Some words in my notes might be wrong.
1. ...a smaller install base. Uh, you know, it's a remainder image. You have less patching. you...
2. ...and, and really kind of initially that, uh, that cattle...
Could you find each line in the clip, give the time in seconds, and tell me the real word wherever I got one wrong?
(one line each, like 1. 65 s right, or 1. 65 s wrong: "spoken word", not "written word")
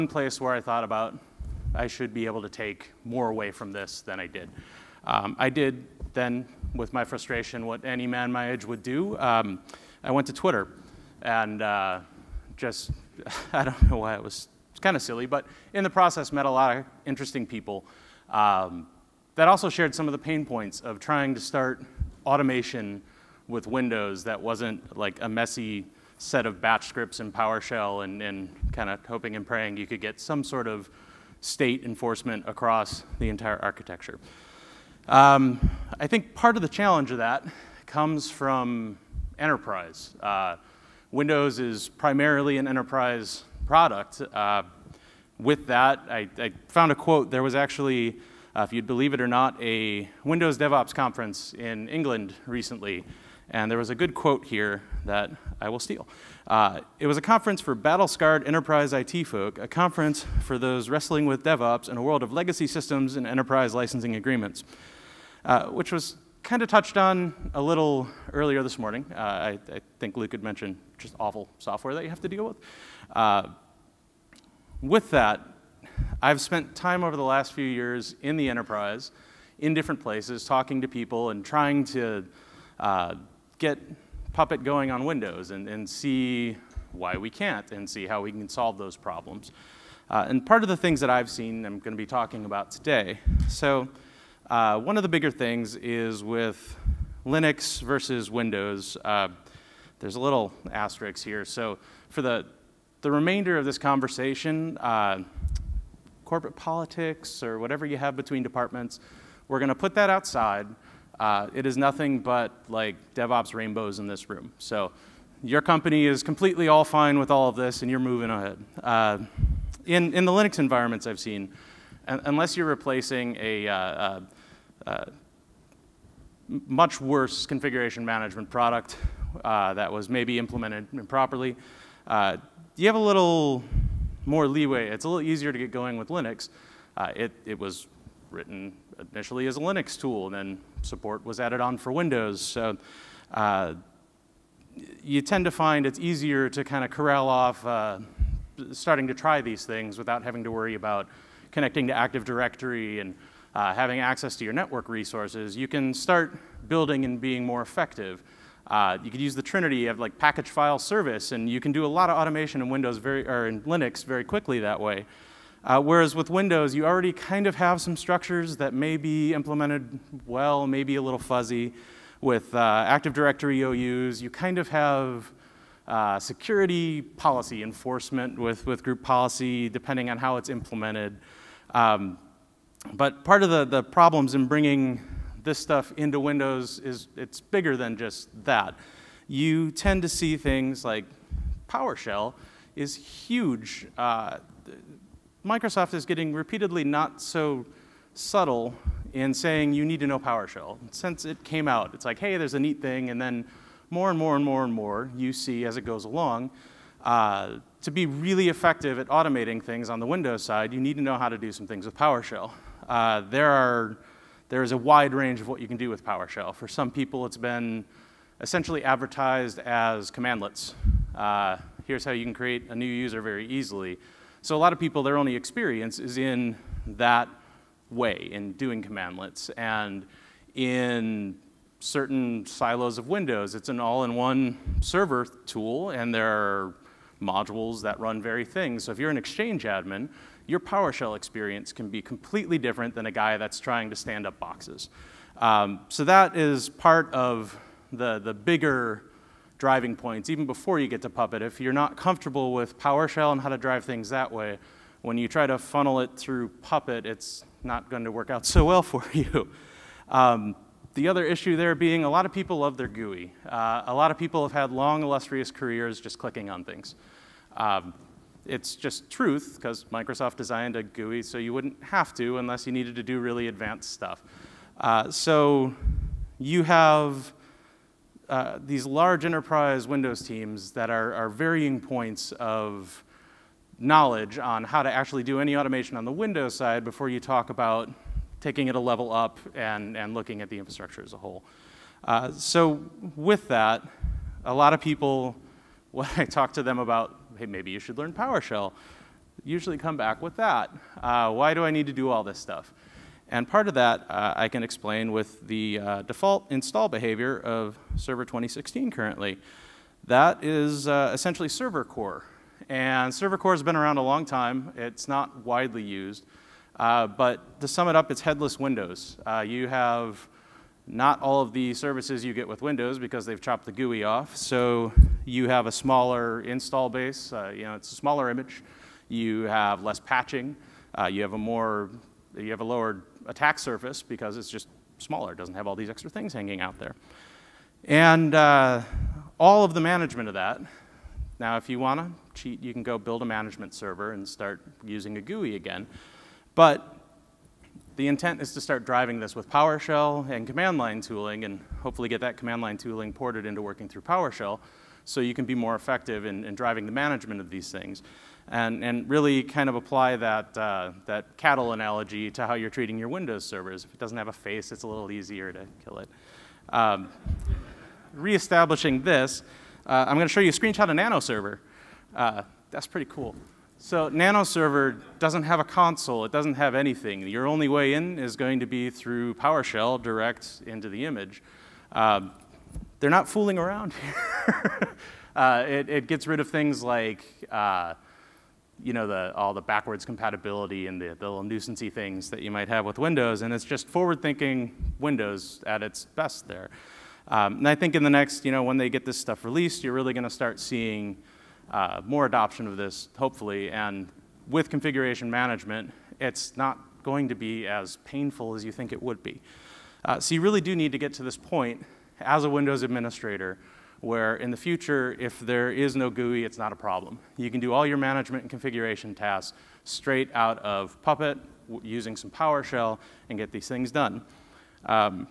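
1. 325 s wrong: "smaller", not "remainder"
2. 358 s wrong: "apply", not "initially".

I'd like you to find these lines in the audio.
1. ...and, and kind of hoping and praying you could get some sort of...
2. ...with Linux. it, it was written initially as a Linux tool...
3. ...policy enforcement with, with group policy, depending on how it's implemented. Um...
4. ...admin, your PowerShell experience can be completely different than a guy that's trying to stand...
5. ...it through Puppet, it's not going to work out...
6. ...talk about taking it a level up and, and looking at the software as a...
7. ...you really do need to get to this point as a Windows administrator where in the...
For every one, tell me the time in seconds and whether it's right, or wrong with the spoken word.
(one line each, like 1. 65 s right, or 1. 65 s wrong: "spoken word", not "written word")
1. 28 s right
2. 135 s right
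3. 177 s right
4. 239 s right
5. 256 s right
6. 287 s wrong: "infrastructure", not "software"
7. 410 s right.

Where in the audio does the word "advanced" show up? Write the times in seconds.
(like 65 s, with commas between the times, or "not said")
273 s.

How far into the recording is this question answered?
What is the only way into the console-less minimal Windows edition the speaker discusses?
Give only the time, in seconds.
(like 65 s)
379 s.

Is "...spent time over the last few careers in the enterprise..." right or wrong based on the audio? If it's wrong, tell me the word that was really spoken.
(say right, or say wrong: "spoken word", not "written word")
wrong: "years", not "careers".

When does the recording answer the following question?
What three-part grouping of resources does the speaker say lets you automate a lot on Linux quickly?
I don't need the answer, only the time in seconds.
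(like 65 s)
160 s.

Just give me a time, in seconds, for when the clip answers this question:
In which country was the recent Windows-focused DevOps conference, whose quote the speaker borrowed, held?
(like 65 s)
51 s.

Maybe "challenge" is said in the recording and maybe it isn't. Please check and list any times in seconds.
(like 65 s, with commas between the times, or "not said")
36 s.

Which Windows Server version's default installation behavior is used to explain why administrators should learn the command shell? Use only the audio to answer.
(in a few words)
Server 2016.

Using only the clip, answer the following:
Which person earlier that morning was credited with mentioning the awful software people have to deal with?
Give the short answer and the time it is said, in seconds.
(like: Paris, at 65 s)
Luke, at 70 s.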